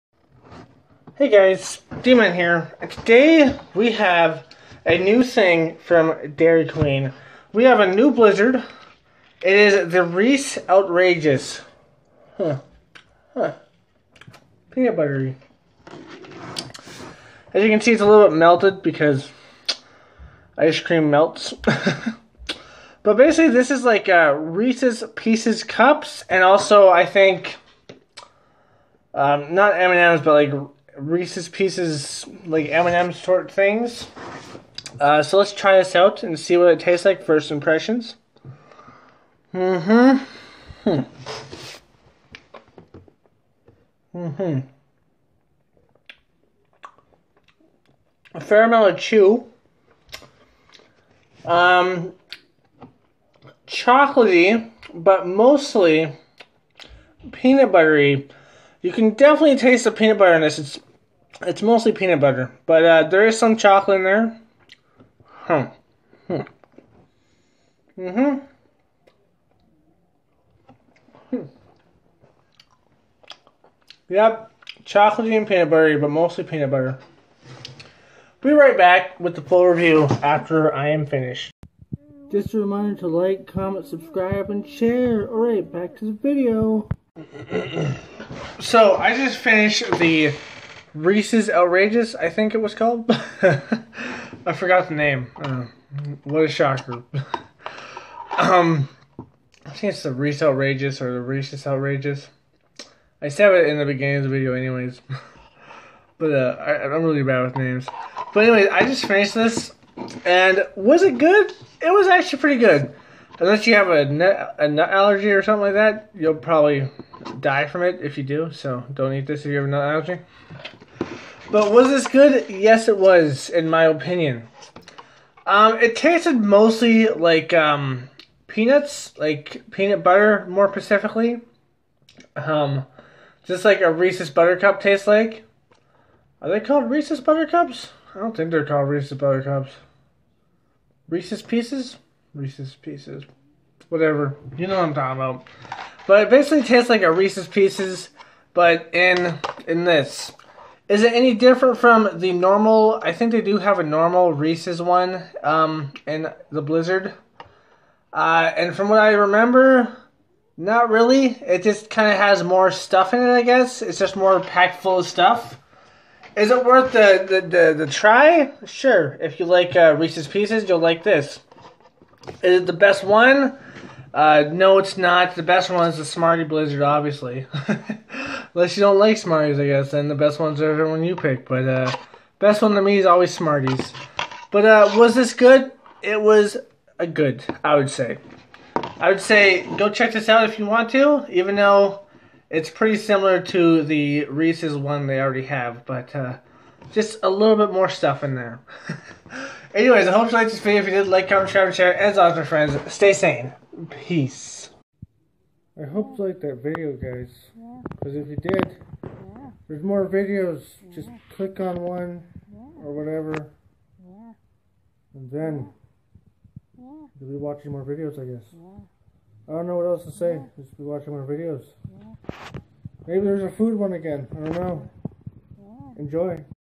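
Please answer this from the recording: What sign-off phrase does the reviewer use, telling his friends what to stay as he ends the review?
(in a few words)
stay sane.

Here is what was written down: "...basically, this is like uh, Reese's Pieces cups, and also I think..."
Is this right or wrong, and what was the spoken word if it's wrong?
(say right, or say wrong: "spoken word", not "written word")
right.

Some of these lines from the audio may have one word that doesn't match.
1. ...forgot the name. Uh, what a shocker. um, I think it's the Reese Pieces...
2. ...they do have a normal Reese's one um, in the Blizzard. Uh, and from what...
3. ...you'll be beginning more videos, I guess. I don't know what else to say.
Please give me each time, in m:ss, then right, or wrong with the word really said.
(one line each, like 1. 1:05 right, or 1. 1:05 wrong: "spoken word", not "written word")
1. 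1:34 wrong: "Outrageous", not "Pieces"
2. 2:33 right
3. 3:36 wrong: "watching", not "beginning".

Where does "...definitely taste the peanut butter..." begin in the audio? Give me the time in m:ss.
0:59.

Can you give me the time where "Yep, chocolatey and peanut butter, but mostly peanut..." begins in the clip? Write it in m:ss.
1:14.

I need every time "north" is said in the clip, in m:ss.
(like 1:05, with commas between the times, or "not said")
not said.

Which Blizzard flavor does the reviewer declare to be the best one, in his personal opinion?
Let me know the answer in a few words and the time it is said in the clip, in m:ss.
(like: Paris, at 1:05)
Smarty Blizzard, at 2:56.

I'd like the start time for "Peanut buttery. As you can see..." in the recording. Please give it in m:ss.
0:14.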